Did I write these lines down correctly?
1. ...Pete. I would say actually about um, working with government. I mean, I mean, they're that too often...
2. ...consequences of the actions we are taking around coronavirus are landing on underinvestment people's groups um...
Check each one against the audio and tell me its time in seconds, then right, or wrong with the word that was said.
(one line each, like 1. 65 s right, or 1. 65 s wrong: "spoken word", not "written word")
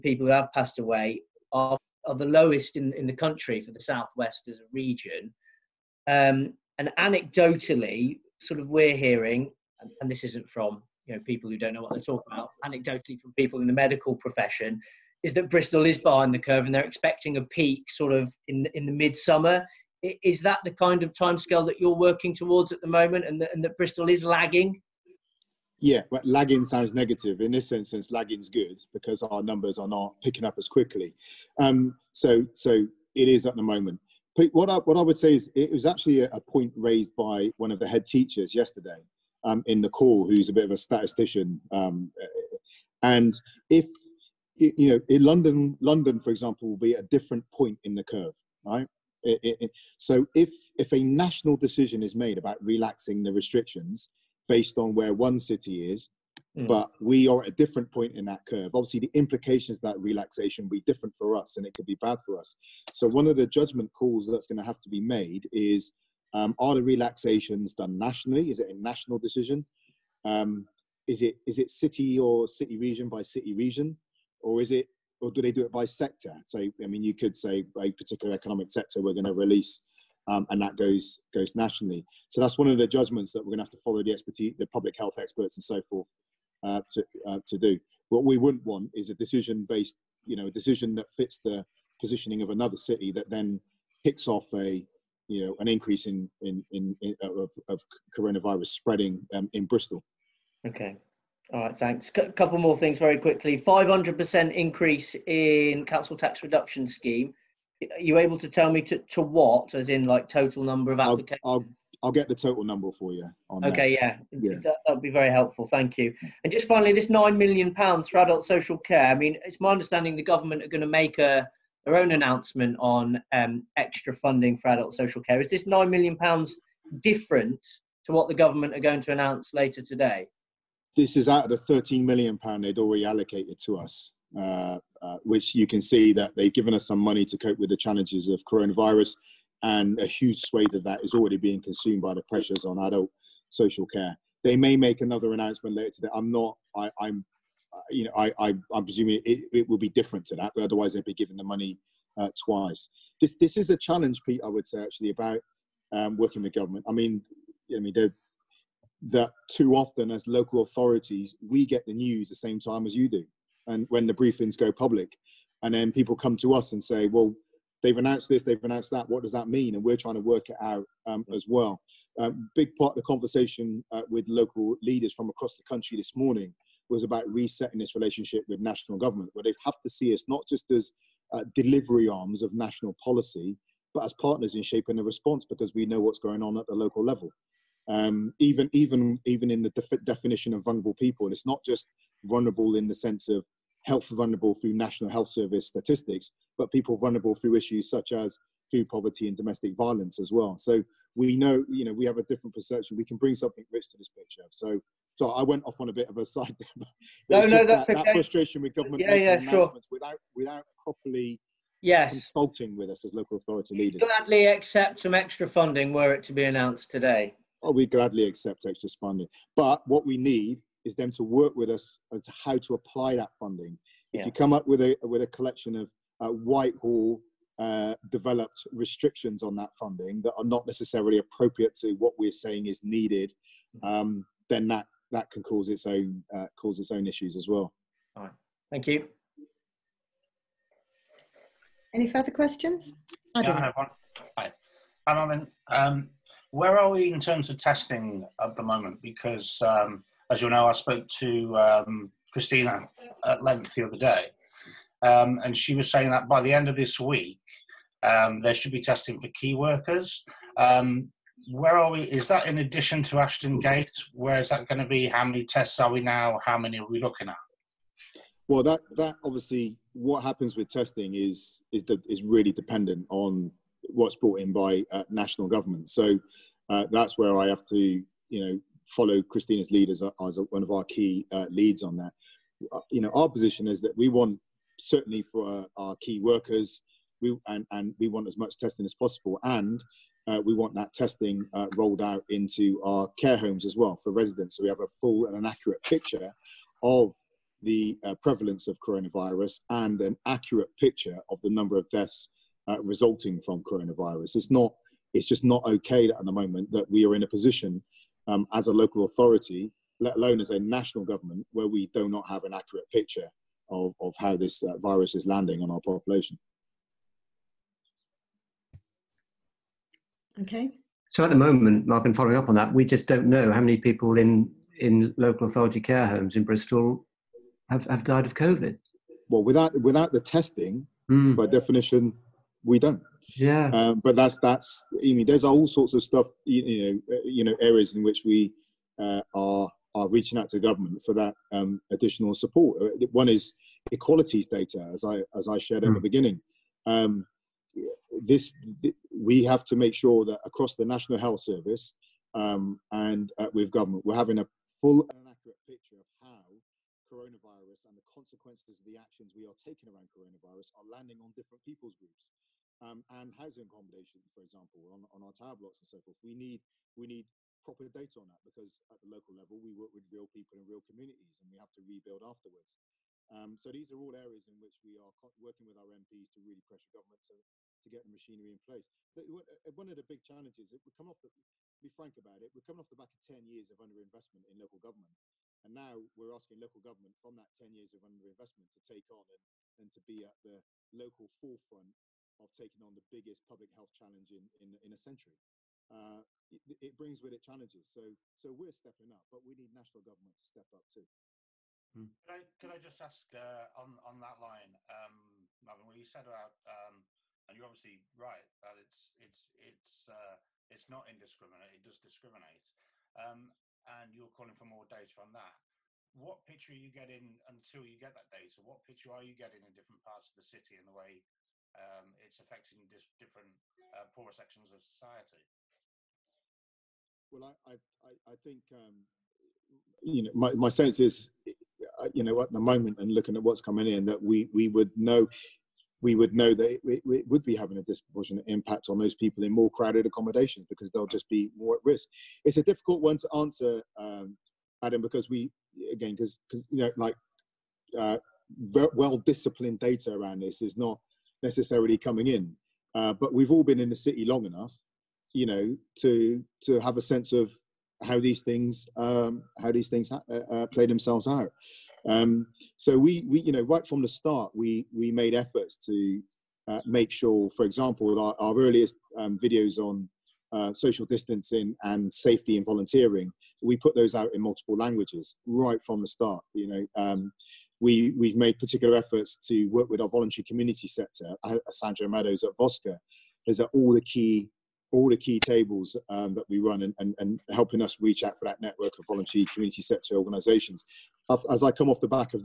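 1. 154 s right
2. 358 s wrong: "different", not "underinvestment".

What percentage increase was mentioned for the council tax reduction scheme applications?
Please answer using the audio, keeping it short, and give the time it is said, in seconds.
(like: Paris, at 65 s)
500%, at 103 s.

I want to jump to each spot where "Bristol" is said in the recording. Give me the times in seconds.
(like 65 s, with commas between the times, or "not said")
15 s, 23 s, 99 s, 326 s.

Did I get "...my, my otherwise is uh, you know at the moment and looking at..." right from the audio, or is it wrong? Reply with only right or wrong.
wrong.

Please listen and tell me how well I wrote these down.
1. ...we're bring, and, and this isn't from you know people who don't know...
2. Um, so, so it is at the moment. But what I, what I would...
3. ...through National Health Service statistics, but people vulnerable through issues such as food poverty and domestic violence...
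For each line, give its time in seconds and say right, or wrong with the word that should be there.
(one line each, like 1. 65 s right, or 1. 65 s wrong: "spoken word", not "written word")
1. 8 s wrong: "hearing", not "bring"
2. 31 s right
3. 194 s right.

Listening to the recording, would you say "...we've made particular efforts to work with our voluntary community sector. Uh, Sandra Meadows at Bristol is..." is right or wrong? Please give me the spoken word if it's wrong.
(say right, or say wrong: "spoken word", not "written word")
wrong: "Voscur", not "Bristol".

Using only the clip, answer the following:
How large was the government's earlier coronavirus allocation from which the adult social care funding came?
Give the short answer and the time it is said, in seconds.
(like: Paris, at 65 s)
13 million pounds, at 131 s.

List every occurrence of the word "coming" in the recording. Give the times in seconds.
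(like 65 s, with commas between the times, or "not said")
382 s, 433 s, 451 s.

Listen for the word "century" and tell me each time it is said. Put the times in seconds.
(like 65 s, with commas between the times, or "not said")
394 s.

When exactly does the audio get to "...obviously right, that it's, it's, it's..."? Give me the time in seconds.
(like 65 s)
407 s.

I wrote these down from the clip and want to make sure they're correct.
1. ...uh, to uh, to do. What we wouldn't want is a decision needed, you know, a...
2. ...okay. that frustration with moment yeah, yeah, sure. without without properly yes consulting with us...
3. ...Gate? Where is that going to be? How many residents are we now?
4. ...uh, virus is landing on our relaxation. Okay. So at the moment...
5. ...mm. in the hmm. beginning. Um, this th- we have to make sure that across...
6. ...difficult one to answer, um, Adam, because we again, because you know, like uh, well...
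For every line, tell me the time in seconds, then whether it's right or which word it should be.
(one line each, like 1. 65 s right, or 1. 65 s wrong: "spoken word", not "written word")
1. 86 s wrong: "based", not "needed"
2. 207 s wrong: "government", not "moment"
3. 263 s wrong: "tests", not "residents"
4. 314 s wrong: "population", not "relaxation"
5. 345 s right
6. 442 s right.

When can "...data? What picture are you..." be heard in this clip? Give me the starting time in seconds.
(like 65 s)
418 s.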